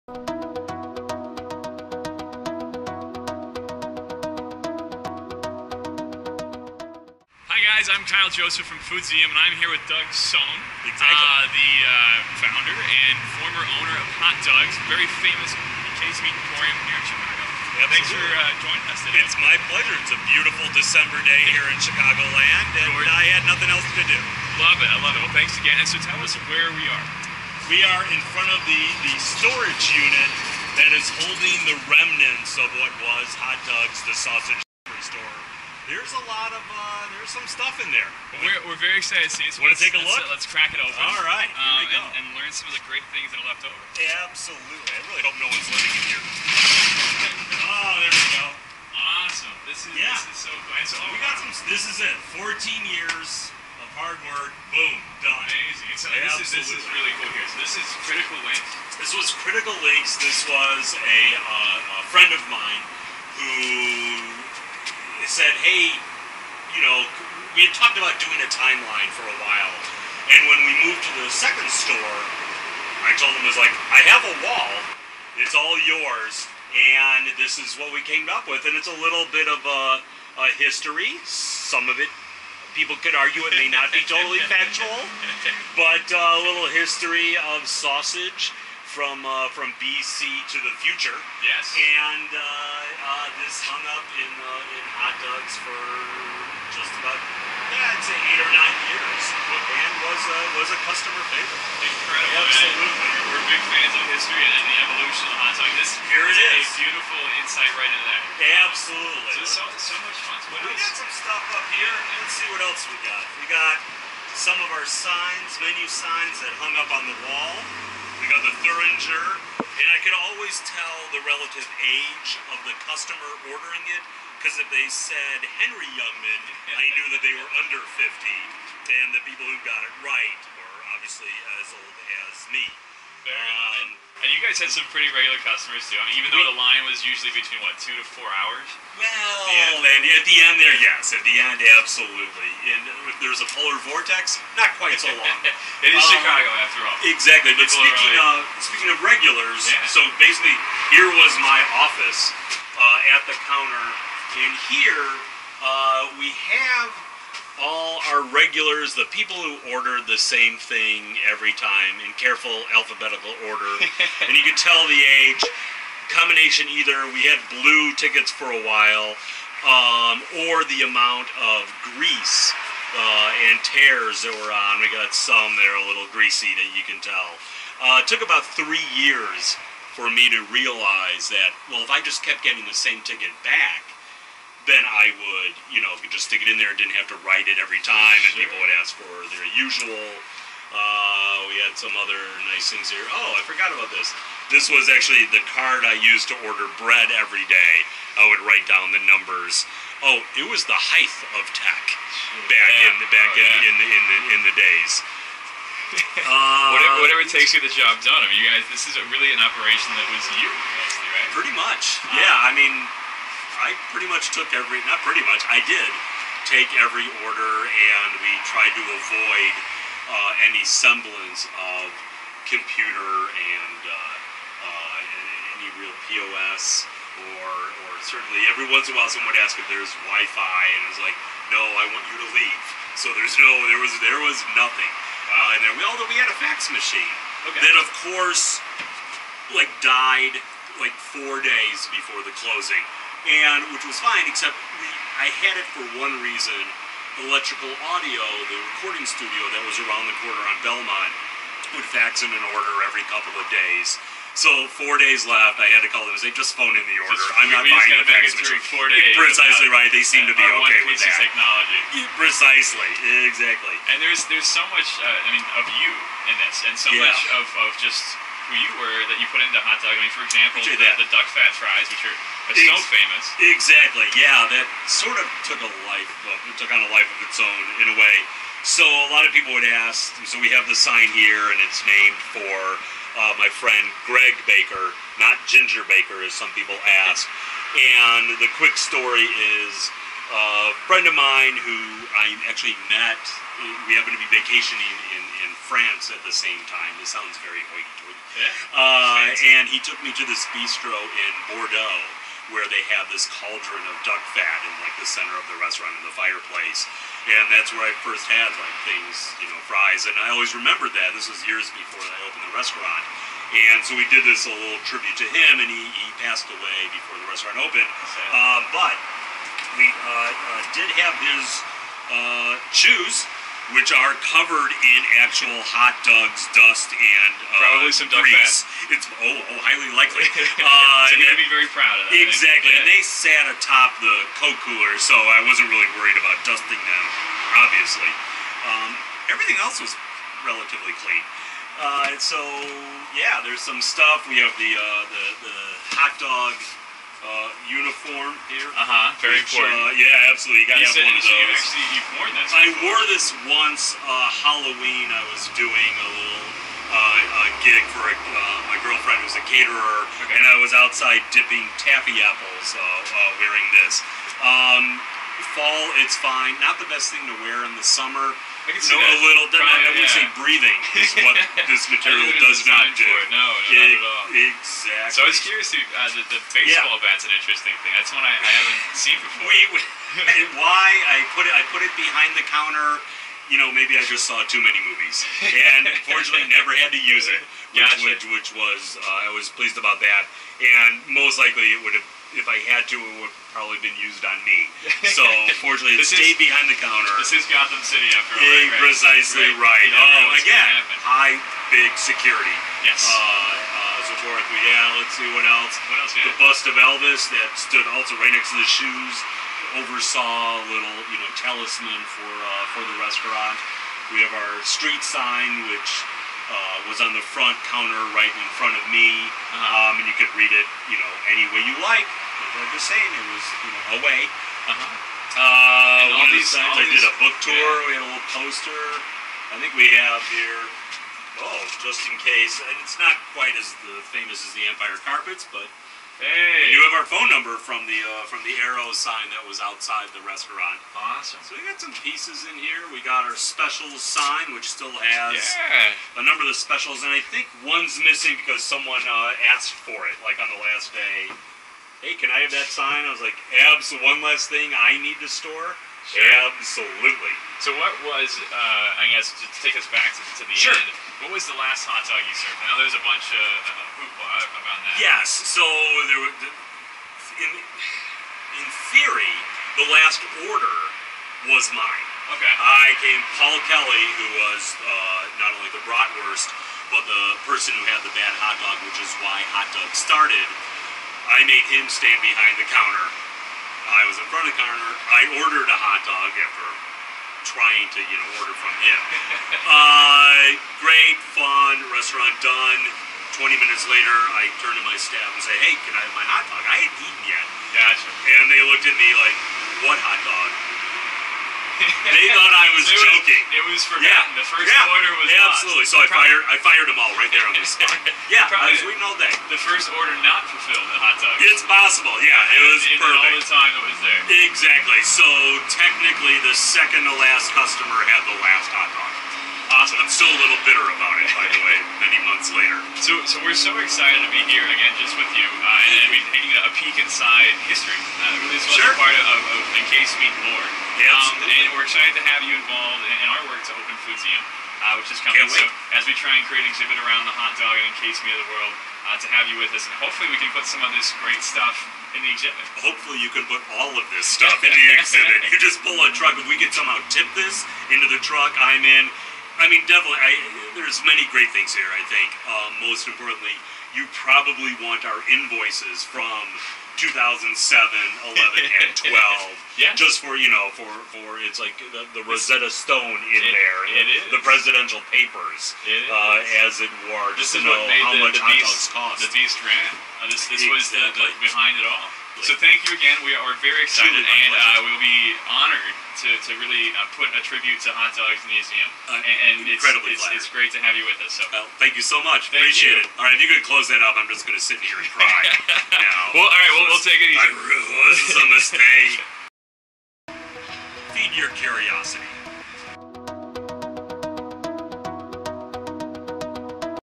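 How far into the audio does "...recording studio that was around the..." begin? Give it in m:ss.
4:08.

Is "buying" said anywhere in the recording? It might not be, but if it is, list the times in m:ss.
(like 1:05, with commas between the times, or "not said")
4:17.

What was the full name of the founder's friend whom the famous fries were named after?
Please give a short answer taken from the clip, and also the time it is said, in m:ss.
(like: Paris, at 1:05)
Greg Baker, at 4:44.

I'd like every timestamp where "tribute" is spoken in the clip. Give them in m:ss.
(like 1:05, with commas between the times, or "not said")
5:14, 9:37.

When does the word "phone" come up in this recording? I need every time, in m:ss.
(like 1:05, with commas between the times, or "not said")
4:16, 7:17.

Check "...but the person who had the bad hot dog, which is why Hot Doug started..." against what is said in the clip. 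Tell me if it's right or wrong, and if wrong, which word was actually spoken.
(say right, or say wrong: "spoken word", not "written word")
right.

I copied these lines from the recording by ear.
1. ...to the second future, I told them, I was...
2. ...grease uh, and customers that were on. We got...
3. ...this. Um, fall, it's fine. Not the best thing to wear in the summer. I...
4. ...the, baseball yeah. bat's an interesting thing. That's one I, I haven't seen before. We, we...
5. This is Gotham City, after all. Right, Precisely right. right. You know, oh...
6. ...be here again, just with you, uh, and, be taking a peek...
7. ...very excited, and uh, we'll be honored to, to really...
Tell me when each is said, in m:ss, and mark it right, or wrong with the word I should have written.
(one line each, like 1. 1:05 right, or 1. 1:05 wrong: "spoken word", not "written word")
1. 1:11 wrong: "store", not "future"
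2. 2:51 wrong: "tears", not "customers"
3. 6:03 right
4. 6:16 right
5. 6:37 right
6. 8:44 right
7. 9:33 right.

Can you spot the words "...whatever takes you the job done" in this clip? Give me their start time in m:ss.
3:27.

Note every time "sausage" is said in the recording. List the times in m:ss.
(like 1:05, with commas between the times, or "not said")
0:34, 1:27.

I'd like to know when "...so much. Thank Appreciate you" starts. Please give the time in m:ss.
9:42.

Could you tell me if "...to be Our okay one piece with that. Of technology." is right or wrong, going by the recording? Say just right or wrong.
right.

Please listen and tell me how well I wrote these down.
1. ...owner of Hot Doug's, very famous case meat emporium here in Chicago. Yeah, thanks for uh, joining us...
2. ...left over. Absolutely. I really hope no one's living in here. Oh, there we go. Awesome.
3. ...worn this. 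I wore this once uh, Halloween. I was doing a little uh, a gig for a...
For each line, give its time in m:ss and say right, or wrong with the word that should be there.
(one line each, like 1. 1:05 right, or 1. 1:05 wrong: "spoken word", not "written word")
1. 0:13 right
2. 0:43 right
3. 5:52 right.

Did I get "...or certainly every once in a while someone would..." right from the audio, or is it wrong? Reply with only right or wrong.
right.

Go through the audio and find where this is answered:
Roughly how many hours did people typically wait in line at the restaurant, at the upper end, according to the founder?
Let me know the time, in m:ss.
2:18.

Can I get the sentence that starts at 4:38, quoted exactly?
So a lot of people would ask.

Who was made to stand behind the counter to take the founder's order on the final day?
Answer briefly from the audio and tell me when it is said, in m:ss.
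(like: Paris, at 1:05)
Paul Kelly, at 7:53.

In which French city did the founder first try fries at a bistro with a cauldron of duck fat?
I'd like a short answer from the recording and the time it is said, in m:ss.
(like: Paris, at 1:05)
Bordeaux, at 5:01.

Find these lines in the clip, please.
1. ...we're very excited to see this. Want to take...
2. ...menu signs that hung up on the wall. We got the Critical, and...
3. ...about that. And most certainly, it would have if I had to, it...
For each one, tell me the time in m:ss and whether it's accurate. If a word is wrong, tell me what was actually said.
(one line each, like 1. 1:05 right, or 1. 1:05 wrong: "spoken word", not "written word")
1. 0:38 right
2. 1:55 wrong: "Thuringer", not "Critical"
3. 6:29 wrong: "likely", not "certainly".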